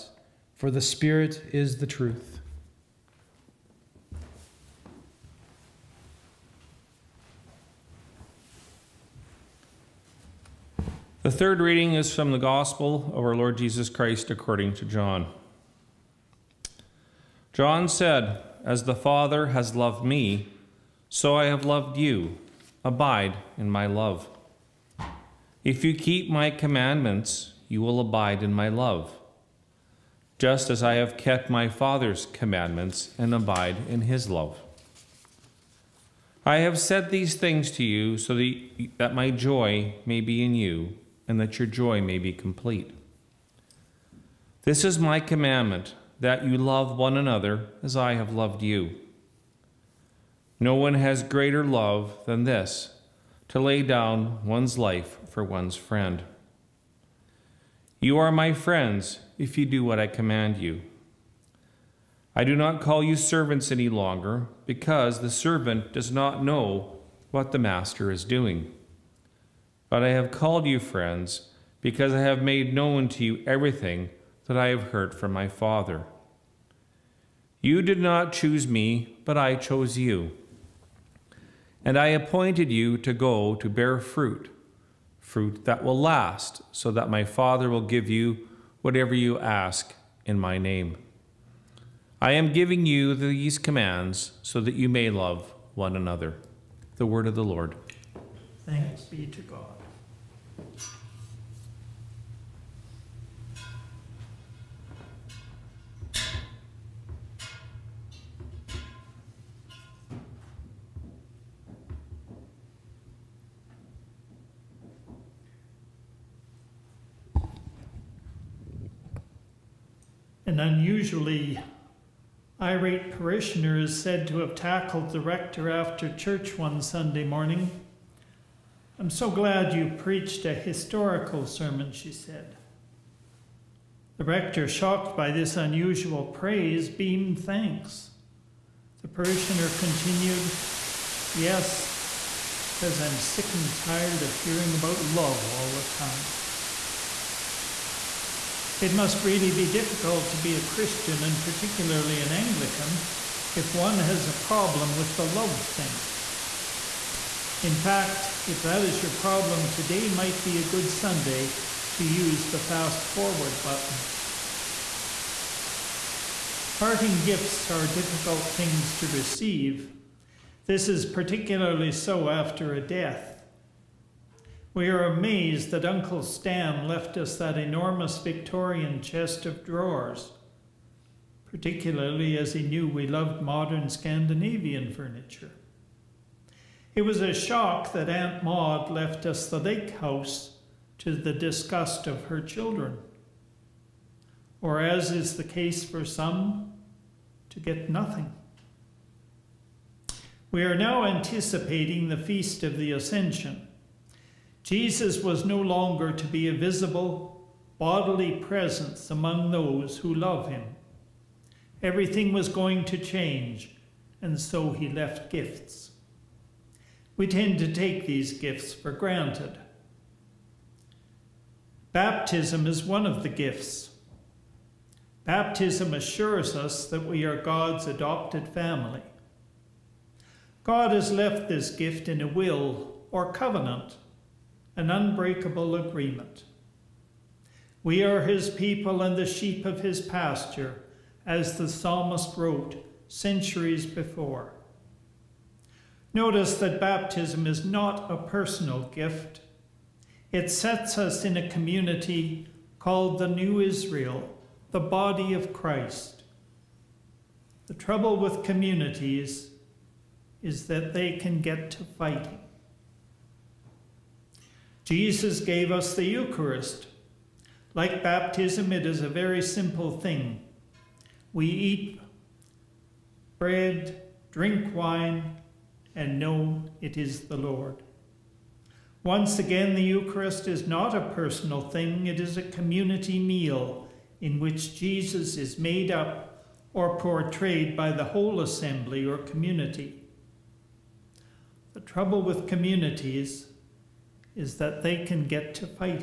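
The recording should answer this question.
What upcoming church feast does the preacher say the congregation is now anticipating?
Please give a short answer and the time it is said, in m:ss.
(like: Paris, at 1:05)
Feast of the Ascension, at 3:22.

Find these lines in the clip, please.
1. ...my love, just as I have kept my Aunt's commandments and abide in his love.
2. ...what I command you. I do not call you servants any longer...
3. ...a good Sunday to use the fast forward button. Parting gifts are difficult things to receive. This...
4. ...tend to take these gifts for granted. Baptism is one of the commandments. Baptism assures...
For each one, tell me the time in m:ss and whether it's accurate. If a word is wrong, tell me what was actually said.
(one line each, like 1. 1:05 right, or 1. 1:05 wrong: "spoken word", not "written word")
1. 0:28 wrong: "Father", not "Aunt"
2. 0:59 right
3. 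2:40 right
4. 3:37 wrong: "gifts", not "commandments".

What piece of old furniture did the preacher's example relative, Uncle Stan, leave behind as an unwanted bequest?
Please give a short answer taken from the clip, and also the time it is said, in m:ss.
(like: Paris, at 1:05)
Victorian chest of drawers, at 2:58.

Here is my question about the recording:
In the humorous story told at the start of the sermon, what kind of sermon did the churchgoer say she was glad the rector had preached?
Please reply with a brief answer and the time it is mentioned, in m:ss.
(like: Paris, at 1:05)
historical, at 2:10.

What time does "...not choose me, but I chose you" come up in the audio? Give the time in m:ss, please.
1:17.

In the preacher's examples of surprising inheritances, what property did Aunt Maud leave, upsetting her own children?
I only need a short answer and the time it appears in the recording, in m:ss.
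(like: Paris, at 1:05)
the lake house, at 3:09.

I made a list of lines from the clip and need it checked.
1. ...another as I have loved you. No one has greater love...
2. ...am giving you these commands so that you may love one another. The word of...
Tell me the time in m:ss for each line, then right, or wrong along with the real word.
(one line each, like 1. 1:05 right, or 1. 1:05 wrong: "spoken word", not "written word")
1. 0:47 right
2. 1:32 right.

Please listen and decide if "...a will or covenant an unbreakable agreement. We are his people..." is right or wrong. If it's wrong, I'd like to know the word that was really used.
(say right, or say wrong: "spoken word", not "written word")
right.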